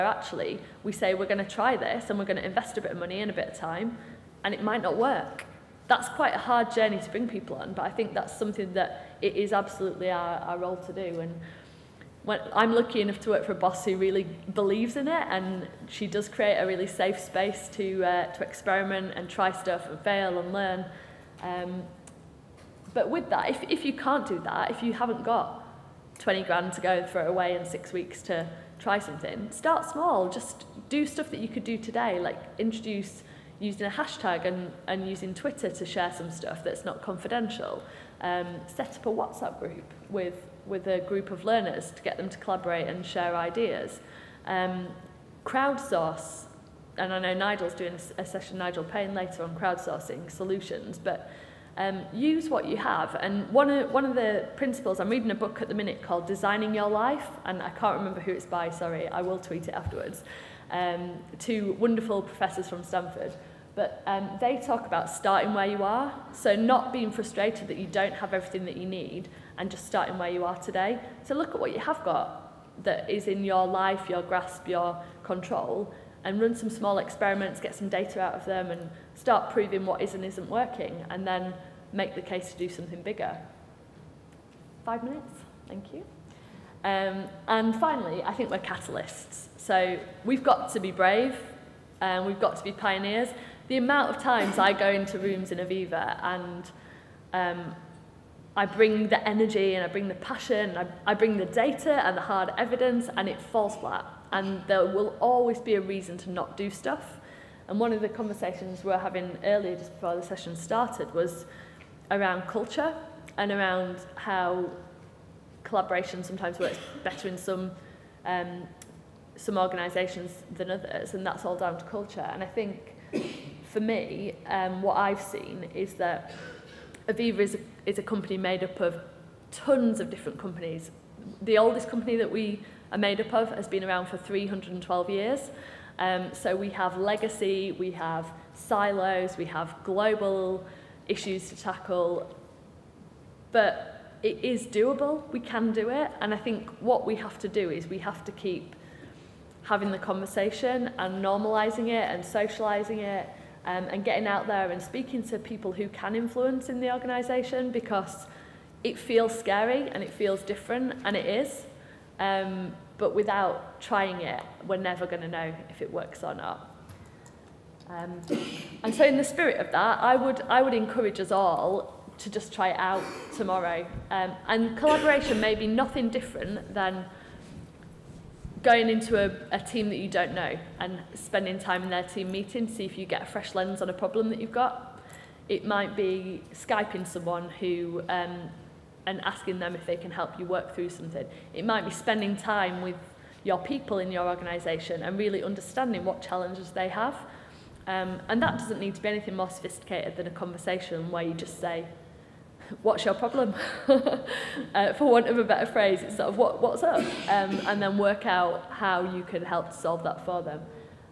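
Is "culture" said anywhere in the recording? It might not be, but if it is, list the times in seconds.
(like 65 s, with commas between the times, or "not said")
112 s, 121 s.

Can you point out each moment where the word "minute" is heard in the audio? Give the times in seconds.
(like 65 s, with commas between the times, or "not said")
55 s, 85 s.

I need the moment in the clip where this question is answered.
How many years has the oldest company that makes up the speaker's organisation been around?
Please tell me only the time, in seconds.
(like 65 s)
134 s.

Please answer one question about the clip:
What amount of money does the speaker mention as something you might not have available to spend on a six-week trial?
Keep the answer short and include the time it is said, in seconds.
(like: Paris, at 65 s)
20 grand, at 26 s.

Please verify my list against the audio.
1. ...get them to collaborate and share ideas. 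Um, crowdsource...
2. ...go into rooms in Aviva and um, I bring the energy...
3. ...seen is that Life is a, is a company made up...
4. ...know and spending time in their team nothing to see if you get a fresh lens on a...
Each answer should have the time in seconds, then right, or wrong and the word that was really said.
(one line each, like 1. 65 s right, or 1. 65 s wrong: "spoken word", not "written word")
1. 42 s right
2. 94 s right
3. 125 s wrong: "Aviva", not "Life"
4. 180 s wrong: "meeting", not "nothing".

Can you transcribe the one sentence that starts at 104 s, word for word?
And there will always be a reason to not do stuff.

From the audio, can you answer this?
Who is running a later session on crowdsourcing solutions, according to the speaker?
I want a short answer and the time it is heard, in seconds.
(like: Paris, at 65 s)
Nigel Paine, at 48 s.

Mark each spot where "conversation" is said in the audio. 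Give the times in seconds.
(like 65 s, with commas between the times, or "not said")
108 s, 149 s, 200 s.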